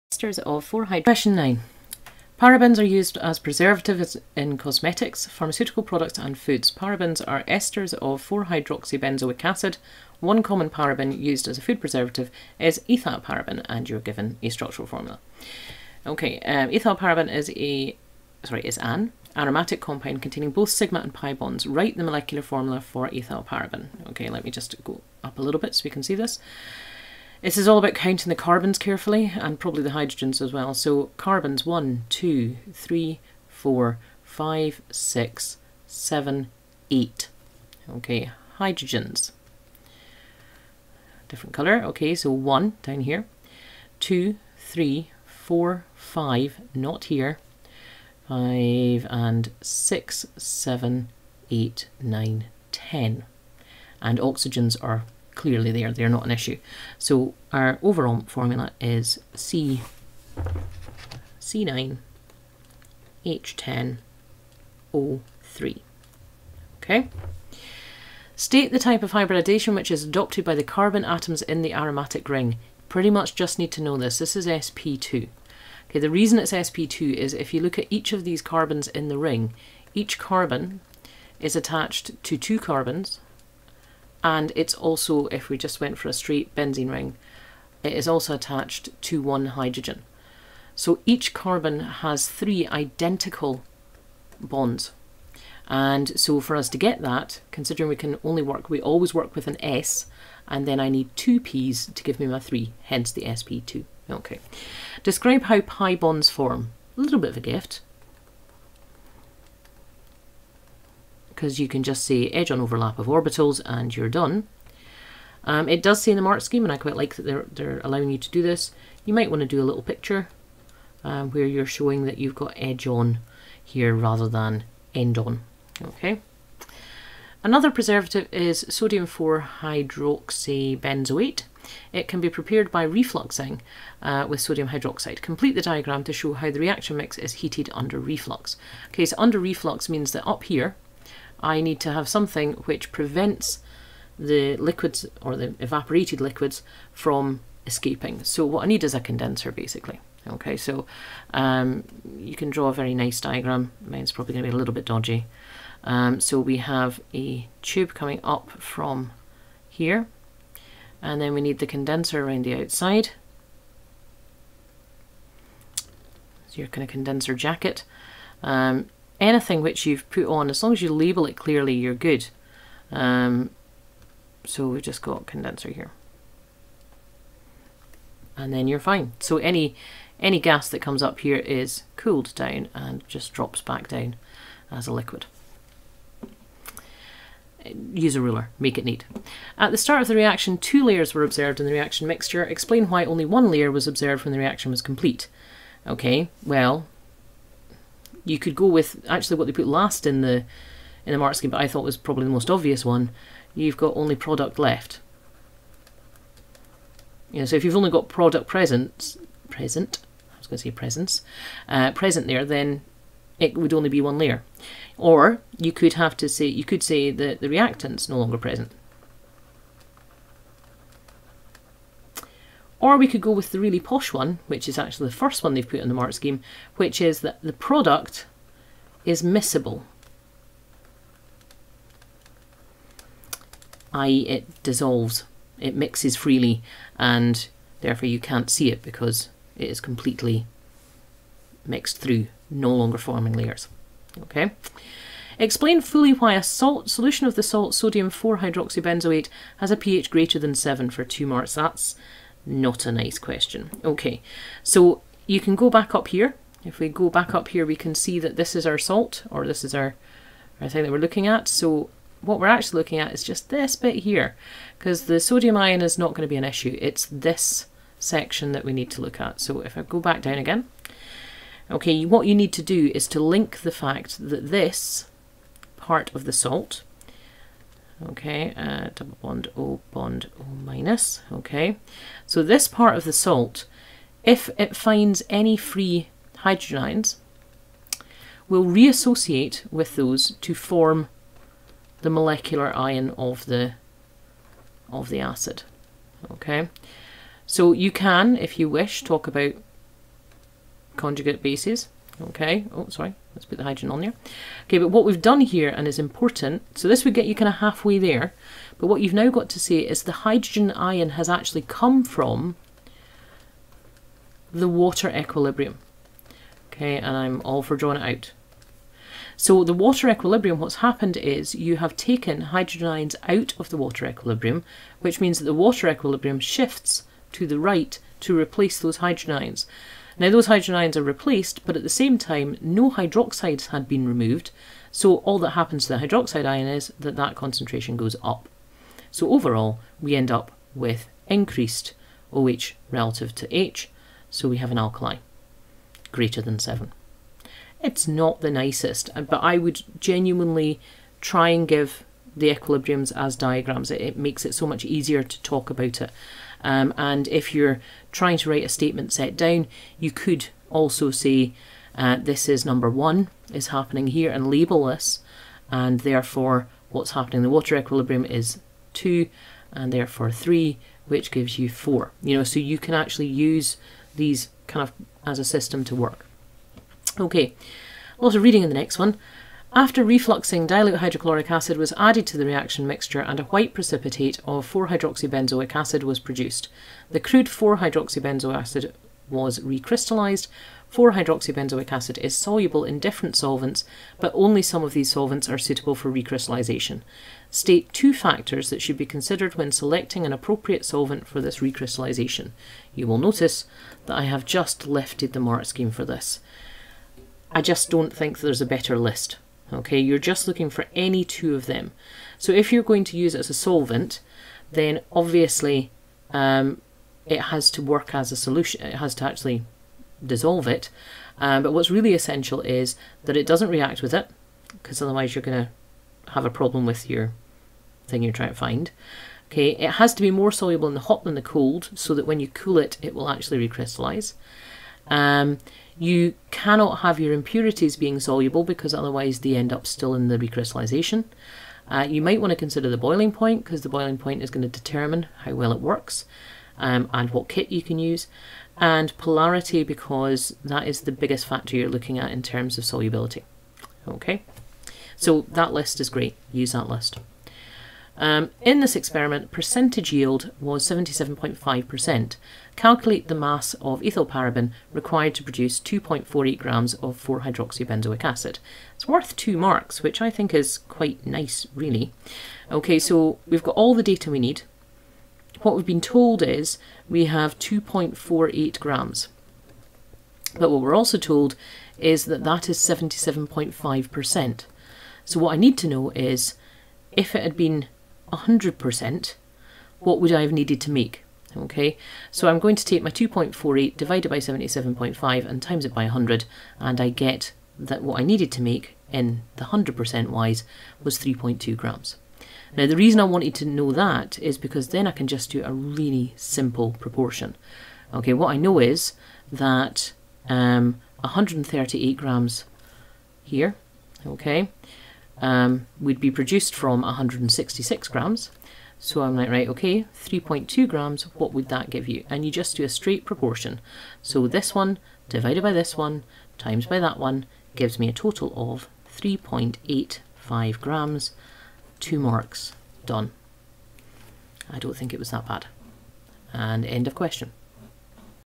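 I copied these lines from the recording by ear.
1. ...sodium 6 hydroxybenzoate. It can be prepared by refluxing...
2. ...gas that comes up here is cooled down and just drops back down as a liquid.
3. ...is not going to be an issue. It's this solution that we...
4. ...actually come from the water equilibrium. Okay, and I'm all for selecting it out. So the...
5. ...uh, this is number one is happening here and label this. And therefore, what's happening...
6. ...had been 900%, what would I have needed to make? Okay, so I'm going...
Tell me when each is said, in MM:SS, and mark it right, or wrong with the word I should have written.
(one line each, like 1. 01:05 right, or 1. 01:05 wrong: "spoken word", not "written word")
1. 02:08 wrong: "4", not "6"
2. 03:00 right
3. 04:25 wrong: "section", not "solution"
4. 05:11 wrong: "drawing", not "selecting"
5. 06:01 right
6. 08:07 wrong: "100", not "900".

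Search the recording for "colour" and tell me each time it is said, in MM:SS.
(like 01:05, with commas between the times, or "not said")
00:41.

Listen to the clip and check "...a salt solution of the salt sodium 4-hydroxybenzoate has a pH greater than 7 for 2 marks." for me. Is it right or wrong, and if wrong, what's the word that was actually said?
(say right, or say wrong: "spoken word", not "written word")
right.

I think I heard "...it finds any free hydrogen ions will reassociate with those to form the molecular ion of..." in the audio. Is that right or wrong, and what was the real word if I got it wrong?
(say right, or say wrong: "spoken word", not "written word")
right.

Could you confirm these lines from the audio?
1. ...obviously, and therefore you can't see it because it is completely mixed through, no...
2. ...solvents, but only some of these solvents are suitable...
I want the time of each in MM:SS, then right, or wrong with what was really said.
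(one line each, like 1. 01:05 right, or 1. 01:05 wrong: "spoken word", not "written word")
1. 03:56 wrong: "freely", not "obviously"
2. 06:33 right.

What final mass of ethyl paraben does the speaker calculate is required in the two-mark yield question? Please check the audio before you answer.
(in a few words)
3.85 grams.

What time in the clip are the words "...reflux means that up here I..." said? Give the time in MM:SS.
02:19.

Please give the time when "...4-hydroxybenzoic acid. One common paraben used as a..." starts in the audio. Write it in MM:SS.
00:08.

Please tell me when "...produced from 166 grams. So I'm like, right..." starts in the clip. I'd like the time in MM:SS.
08:36.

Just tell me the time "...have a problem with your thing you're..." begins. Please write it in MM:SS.
07:06.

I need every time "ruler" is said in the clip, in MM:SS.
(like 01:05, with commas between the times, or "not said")
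03:08.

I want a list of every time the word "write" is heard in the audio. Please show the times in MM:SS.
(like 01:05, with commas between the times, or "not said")
00:21, 05:58.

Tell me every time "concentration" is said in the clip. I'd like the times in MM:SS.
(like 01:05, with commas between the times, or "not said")
05:37.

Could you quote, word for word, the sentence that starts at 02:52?
Um, so we've just got condenser here.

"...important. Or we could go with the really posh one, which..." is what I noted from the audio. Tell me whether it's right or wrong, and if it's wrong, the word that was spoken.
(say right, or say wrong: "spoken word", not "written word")
wrong: "present", not "important".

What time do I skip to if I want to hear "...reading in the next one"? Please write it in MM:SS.
06:18.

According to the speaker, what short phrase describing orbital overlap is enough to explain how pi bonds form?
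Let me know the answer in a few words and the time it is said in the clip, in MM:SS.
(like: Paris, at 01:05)
edge on overlap, at 01:52.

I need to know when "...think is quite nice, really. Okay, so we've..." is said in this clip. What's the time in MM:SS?
07:50.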